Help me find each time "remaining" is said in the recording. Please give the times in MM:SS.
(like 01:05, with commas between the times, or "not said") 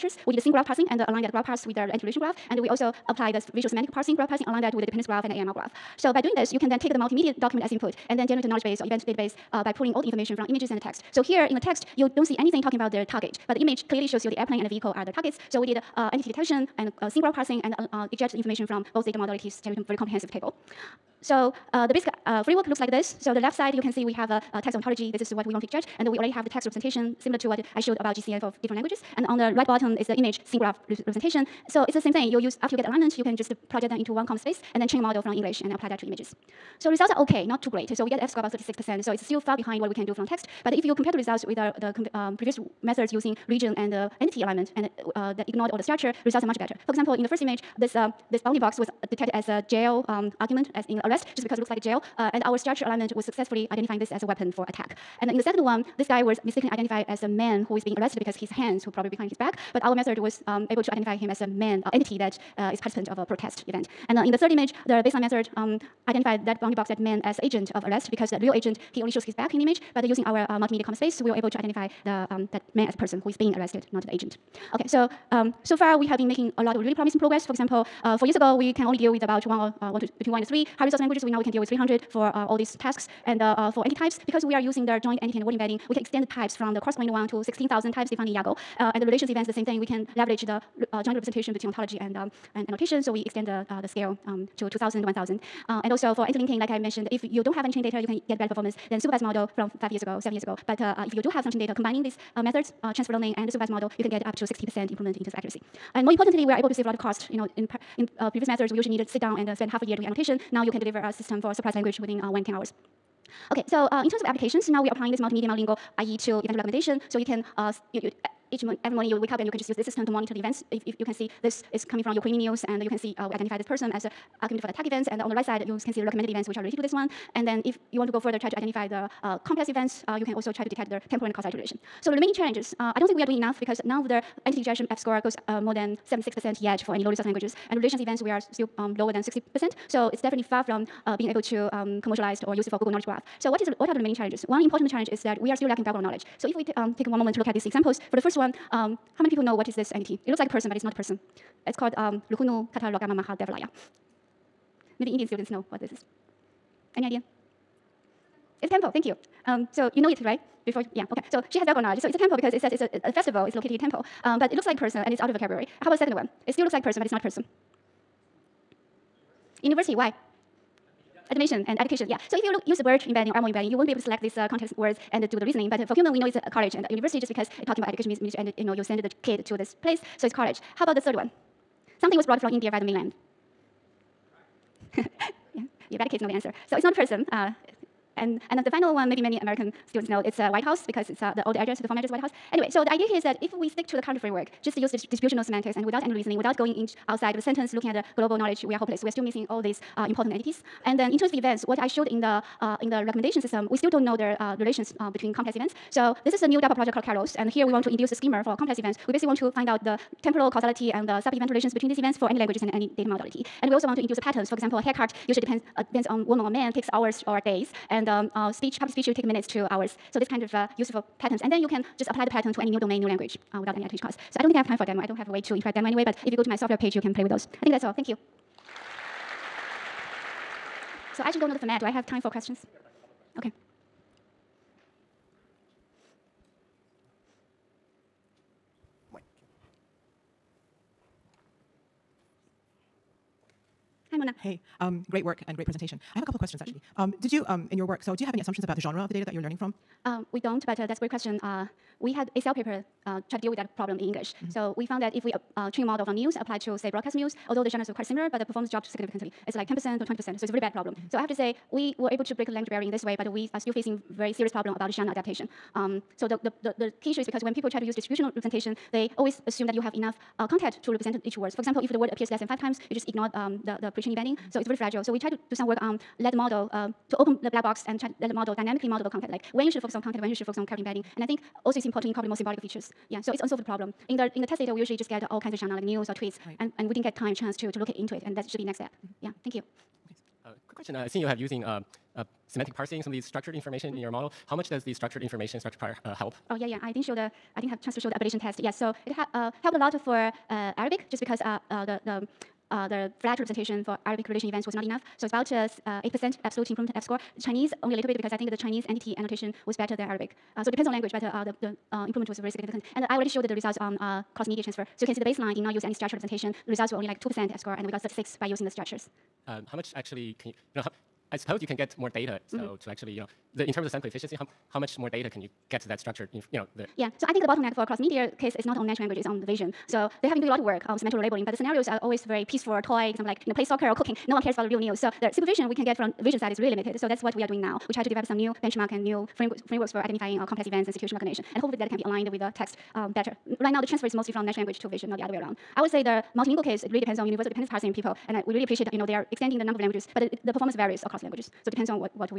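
02:12, 02:23.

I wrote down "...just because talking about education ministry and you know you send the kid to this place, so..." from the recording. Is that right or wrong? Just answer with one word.
right.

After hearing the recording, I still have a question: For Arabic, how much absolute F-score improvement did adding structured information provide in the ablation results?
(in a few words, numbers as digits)
8%.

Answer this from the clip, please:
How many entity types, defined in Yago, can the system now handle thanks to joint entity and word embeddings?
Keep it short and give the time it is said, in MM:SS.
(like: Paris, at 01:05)
16,000, at 01:27.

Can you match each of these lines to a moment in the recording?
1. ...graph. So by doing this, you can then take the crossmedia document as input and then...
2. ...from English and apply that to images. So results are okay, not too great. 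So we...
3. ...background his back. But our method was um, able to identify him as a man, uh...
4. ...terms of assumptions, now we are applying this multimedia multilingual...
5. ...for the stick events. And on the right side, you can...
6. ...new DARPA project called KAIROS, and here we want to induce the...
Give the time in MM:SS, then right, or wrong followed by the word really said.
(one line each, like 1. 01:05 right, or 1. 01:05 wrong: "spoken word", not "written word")
1. 00:05 wrong: "multimedia", not "crossmedia"
2. 00:35 right
3. 00:59 wrong: "behind", not "background"
4. 01:54 wrong: "applications", not "assumptions"
5. 02:04 wrong: "attack", not "stick"
6. 03:26 right.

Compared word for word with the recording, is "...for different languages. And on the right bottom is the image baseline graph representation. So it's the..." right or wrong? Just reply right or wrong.
wrong.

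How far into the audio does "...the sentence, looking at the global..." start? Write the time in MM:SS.
03:17.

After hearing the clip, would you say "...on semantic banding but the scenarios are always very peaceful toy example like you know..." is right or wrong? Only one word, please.
wrong.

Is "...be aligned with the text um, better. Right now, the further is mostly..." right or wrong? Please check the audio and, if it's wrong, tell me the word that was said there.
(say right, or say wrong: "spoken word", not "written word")
wrong: "transfer", not "further".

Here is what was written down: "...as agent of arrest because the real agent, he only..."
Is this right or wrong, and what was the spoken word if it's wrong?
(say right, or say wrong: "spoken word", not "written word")
right.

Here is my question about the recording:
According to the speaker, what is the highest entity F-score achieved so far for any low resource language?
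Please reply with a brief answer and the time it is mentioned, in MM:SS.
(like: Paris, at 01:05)
76%, at 02:16.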